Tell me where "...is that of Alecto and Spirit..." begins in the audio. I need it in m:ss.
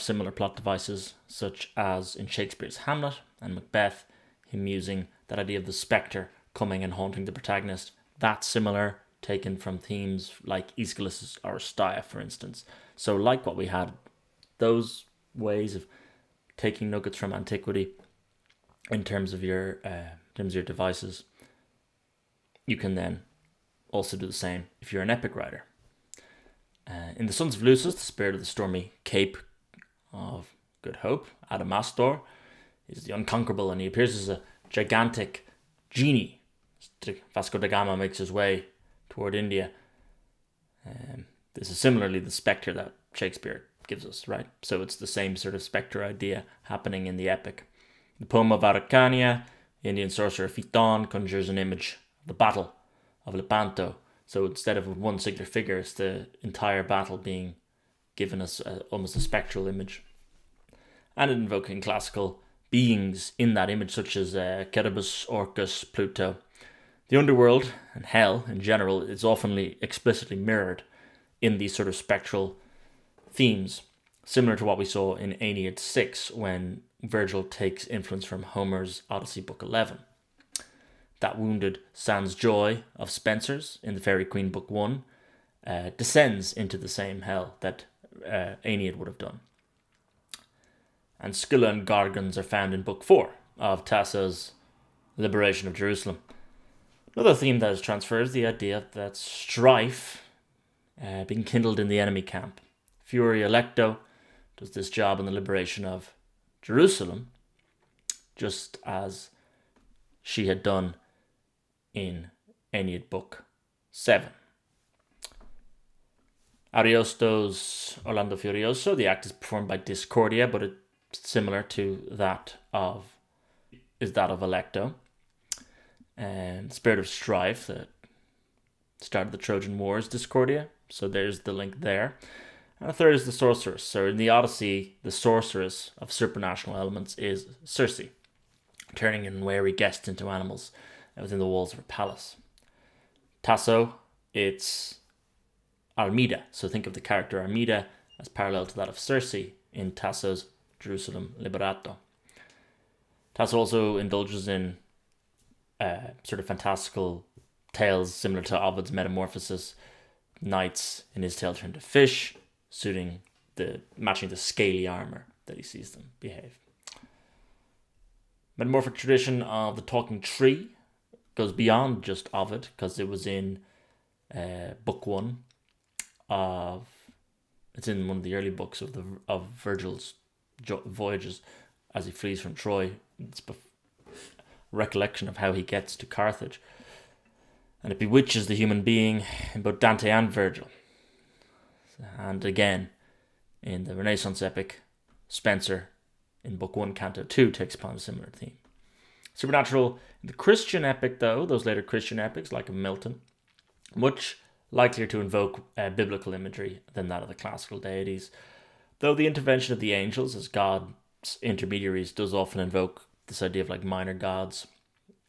2:03.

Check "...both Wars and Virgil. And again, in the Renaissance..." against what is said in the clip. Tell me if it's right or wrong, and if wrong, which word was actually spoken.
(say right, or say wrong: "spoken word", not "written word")
wrong: "Dante", not "Wars".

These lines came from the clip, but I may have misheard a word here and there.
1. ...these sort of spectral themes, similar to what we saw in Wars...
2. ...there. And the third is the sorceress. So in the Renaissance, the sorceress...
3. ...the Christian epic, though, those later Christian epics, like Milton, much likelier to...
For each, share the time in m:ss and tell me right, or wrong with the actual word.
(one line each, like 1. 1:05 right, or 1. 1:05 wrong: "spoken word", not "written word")
1. 1:11 wrong: "Aeneid", not "Wars"
2. 2:11 wrong: "Odyssey", not "Renaissance"
3. 3:20 right.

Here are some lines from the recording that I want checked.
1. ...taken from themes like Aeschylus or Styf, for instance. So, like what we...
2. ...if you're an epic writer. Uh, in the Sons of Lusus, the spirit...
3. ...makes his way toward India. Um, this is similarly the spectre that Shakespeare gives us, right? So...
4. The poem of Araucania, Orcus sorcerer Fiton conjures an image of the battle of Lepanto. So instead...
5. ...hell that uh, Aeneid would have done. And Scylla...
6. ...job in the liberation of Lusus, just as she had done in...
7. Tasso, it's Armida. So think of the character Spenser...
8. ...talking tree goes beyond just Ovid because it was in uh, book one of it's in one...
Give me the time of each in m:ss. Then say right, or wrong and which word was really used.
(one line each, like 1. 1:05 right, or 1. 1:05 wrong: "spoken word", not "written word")
1. 0:09 right
2. 0:24 right
3. 0:37 right
4. 0:48 wrong: "Indian", not "Orcus"
5. 1:27 right
6. 1:44 wrong: "Jerusalem", not "Lusus"
7. 2:23 wrong: "Armida", not "Spenser"
8. 2:49 right.